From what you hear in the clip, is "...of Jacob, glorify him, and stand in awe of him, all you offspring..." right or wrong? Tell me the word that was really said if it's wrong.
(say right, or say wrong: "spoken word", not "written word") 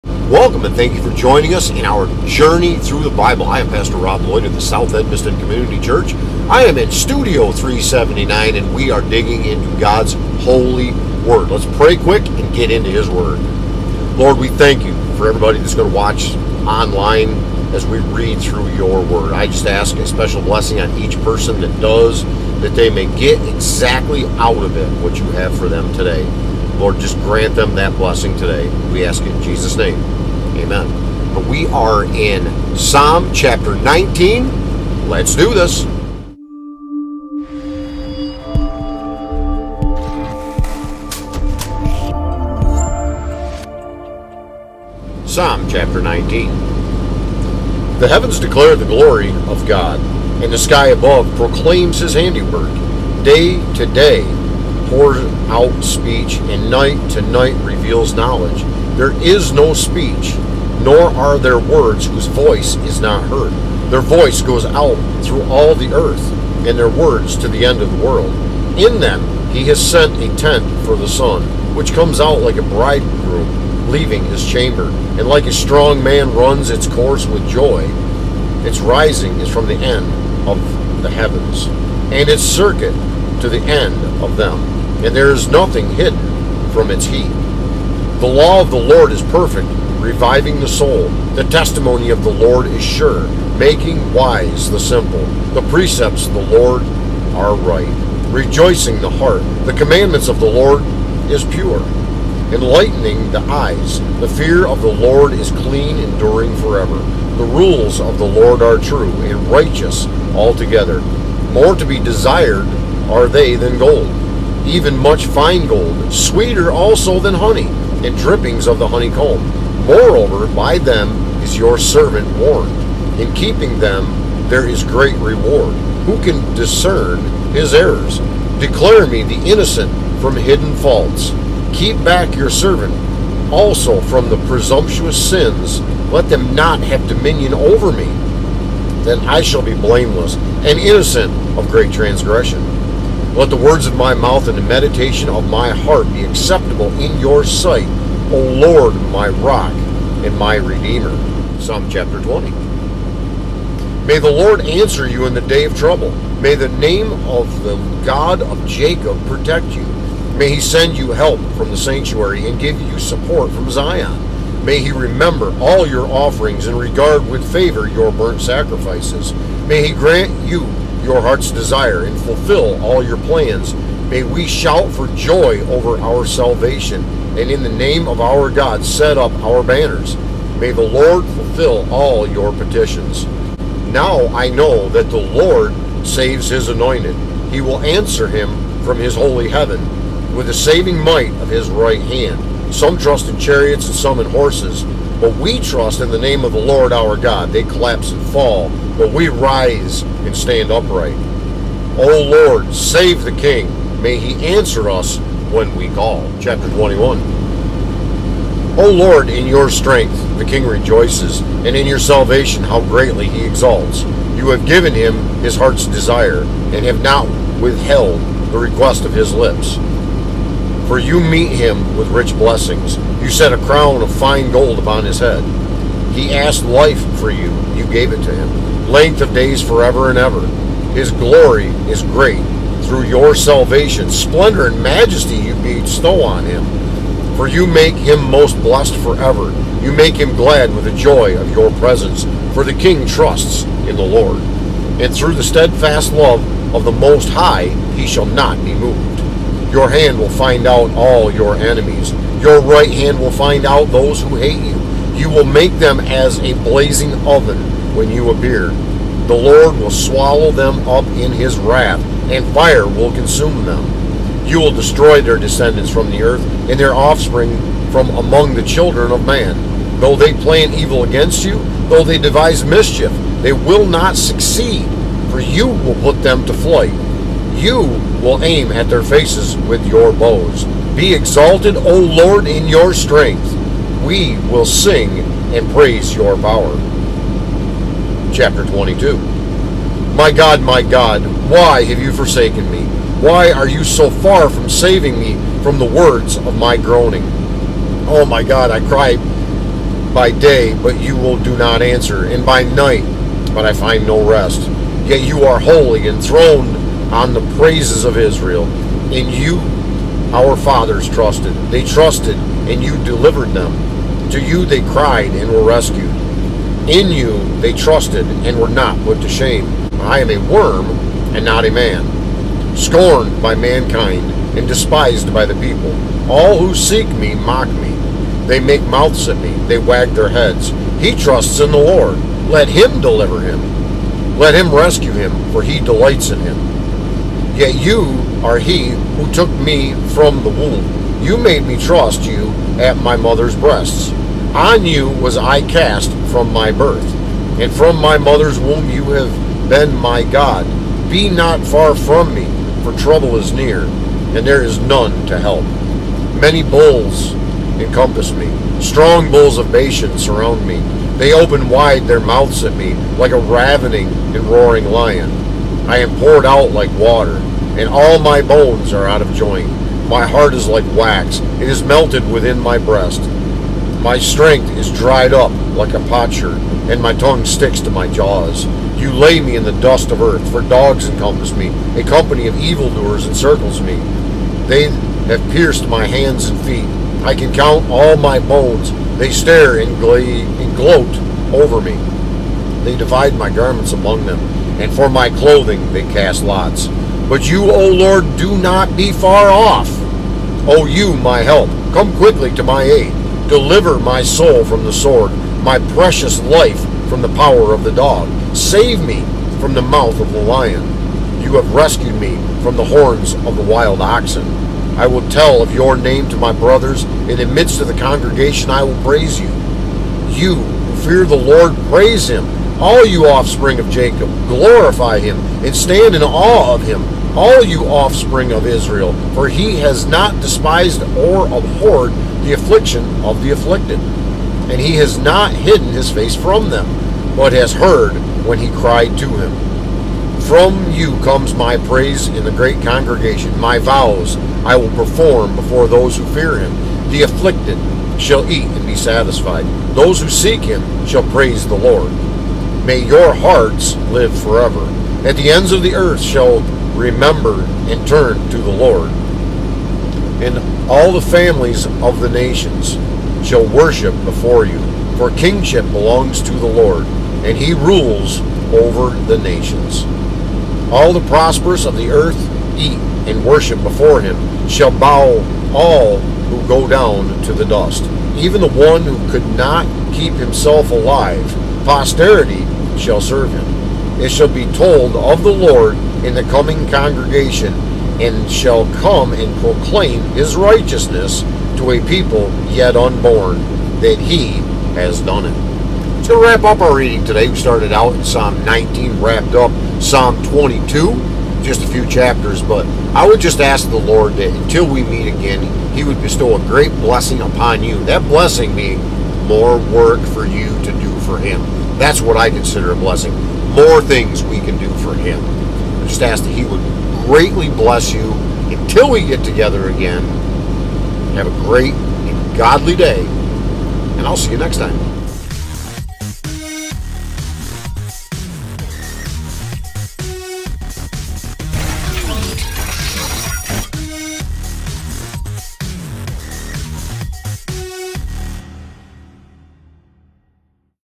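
right.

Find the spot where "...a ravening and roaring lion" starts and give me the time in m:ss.
6:03.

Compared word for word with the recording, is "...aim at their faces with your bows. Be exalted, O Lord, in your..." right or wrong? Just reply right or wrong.
right.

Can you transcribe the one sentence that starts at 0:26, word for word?
Lord, just grant them that blessing today.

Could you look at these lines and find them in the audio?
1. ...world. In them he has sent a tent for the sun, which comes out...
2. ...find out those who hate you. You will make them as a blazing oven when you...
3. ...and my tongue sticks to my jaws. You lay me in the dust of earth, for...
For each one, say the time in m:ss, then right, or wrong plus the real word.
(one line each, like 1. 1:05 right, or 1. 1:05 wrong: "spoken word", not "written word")
1. 1:08 right
2. 4:13 right
3. 6:16 right.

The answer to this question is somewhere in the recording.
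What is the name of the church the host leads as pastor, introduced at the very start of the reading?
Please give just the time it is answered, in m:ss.
0:04.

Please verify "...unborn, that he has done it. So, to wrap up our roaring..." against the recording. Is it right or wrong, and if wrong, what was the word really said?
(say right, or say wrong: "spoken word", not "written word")
wrong: "reading", not "roaring".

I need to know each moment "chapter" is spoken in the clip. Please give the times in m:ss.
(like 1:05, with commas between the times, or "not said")
0:33, 0:45, 2:31, 3:26, 4:48, 8:22.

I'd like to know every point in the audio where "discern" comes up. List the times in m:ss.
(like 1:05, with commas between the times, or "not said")
2:06.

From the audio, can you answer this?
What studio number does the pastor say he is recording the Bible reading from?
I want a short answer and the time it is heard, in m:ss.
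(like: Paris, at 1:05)
379, at 0:07.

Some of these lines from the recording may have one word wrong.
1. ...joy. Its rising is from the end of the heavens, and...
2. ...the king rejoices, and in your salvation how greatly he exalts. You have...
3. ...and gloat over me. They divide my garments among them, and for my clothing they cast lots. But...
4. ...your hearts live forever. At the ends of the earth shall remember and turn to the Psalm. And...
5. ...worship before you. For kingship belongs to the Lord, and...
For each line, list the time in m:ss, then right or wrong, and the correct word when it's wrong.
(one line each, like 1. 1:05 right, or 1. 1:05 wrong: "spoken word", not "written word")
1. 1:17 right
2. 3:30 right
3. 6:30 right
4. 7:32 wrong: "Lord", not "Psalm"
5. 7:43 right.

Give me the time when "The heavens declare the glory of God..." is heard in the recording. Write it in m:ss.
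0:47.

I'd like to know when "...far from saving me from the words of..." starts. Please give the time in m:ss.
4:54.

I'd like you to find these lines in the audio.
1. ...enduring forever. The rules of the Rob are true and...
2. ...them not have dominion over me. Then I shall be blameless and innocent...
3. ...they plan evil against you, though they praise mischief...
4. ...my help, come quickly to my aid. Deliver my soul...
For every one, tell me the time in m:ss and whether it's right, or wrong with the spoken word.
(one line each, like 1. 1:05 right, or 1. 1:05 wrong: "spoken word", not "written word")
1. 1:45 wrong: "Lord", not "Rob"
2. 2:16 right
3. 4:30 wrong: "devise", not "praise"
4. 6:41 right.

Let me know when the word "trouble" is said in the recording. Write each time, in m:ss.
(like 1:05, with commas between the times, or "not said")
2:35, 5:52.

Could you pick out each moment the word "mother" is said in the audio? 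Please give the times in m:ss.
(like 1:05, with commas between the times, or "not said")
5:43, 5:48.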